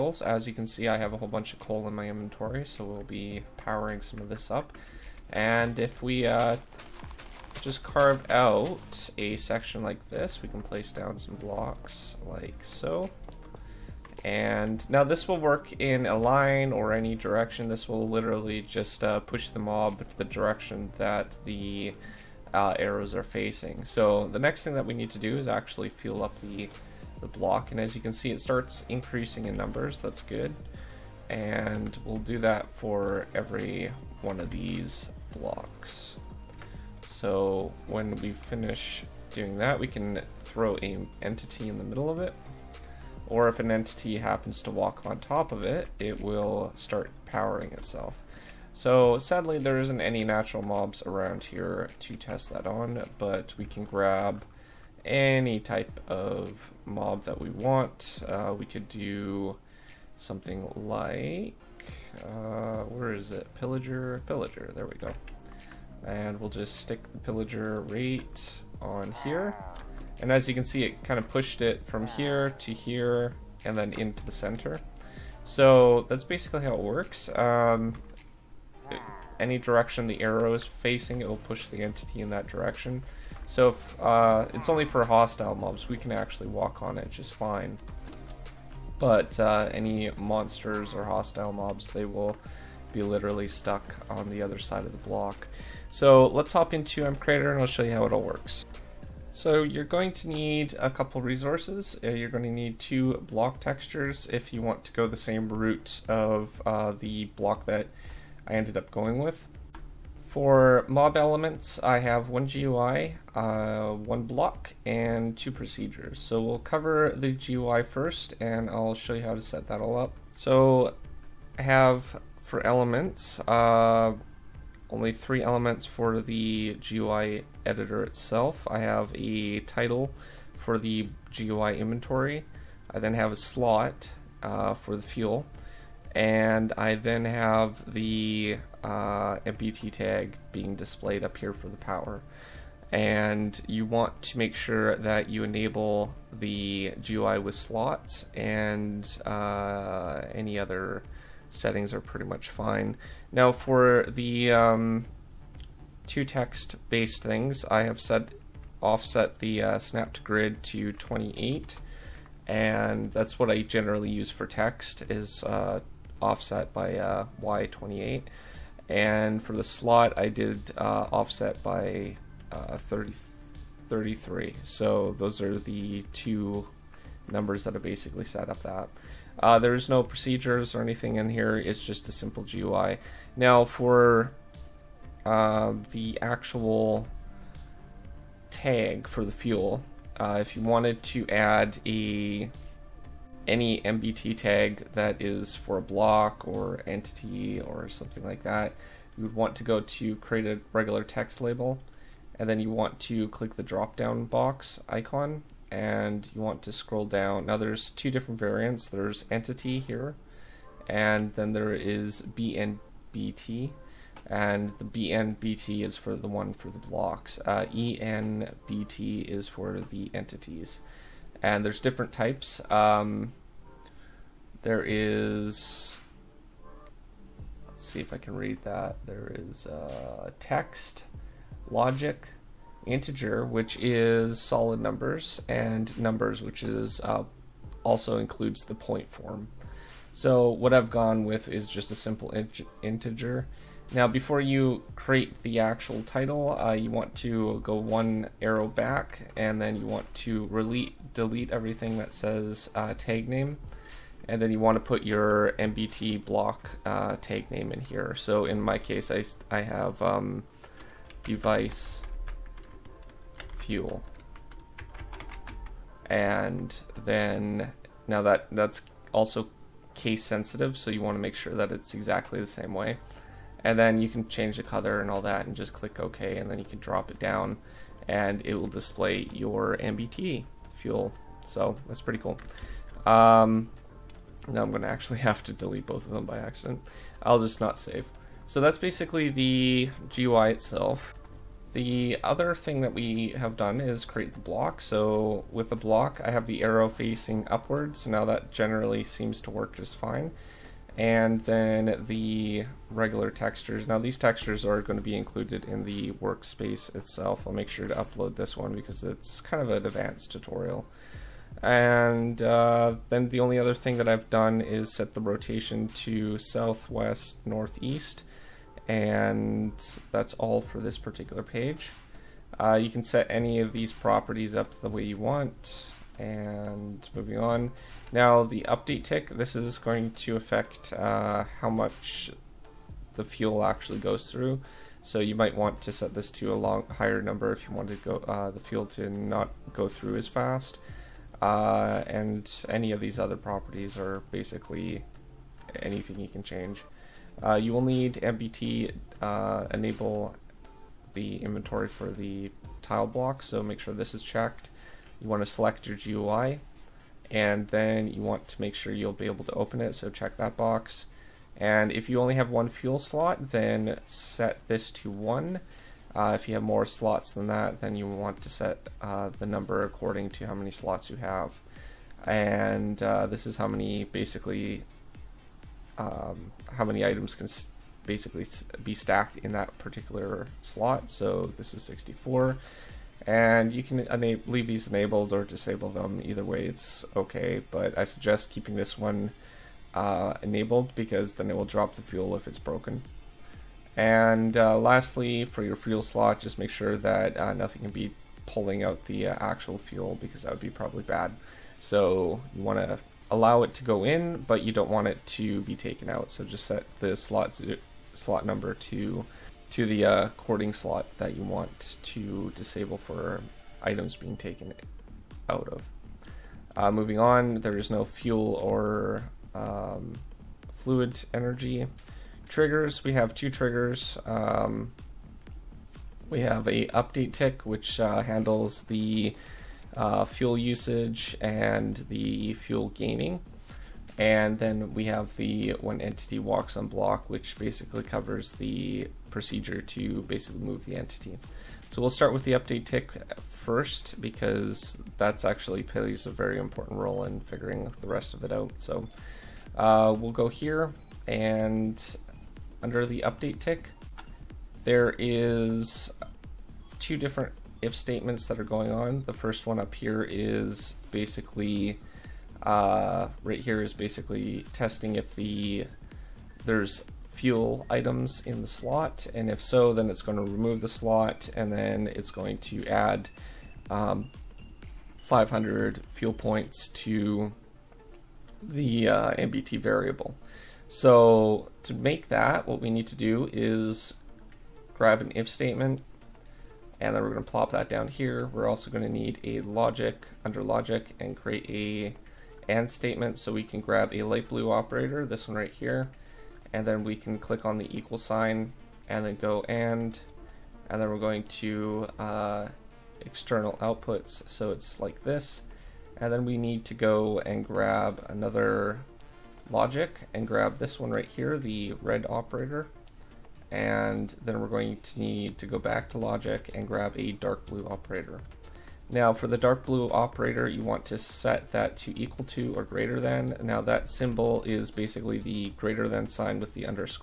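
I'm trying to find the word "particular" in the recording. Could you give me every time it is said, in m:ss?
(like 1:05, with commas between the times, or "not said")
5:20, 6:19.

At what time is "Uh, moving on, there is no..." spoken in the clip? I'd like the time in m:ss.
6:56.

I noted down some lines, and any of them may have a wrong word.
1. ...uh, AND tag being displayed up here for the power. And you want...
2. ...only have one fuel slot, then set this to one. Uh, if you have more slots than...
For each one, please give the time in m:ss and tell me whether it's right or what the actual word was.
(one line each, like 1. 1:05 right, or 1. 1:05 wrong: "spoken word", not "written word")
1. 2:18 wrong: "NBT", not "AND"
2. 6:02 right.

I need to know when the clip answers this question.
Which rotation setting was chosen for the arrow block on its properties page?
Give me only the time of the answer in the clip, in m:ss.
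5:16.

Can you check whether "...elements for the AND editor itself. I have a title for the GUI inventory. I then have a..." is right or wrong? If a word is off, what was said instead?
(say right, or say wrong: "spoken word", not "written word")
wrong: "GUI", not "AND".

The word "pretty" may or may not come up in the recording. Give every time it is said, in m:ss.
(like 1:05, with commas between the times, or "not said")
2:32, 4:42.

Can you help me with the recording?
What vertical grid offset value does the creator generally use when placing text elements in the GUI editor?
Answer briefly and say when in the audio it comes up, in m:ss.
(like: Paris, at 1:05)
28, at 2:47.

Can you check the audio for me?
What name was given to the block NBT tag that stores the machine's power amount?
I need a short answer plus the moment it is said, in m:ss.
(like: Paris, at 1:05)
device fuel, at 4:21.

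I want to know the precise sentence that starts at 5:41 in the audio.
Uh, and any of these other properties are basically anything you can change.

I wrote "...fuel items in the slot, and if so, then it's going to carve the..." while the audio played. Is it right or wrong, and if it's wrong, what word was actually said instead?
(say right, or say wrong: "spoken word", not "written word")
wrong: "remove", not "carve".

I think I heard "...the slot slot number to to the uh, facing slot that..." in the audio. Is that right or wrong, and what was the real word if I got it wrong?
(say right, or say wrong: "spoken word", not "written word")
wrong: "cording", not "facing".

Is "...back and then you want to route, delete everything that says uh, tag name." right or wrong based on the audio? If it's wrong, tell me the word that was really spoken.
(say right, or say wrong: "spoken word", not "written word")
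wrong: "delete", not "route".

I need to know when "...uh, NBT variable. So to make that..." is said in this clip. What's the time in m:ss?
7:59.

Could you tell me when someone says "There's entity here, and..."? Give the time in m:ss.
3:28.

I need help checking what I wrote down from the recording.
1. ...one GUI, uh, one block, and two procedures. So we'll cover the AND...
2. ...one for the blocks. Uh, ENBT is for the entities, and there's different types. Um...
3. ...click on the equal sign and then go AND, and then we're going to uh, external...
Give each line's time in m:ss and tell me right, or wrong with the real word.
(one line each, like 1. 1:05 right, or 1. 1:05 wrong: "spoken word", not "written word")
1. 1:52 wrong: "GUI", not "AND"
2. 3:36 right
3. 8:17 right.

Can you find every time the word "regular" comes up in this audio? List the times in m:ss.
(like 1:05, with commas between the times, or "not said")
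3:20, 5:02.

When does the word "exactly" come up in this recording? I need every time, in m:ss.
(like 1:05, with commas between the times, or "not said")
4:31.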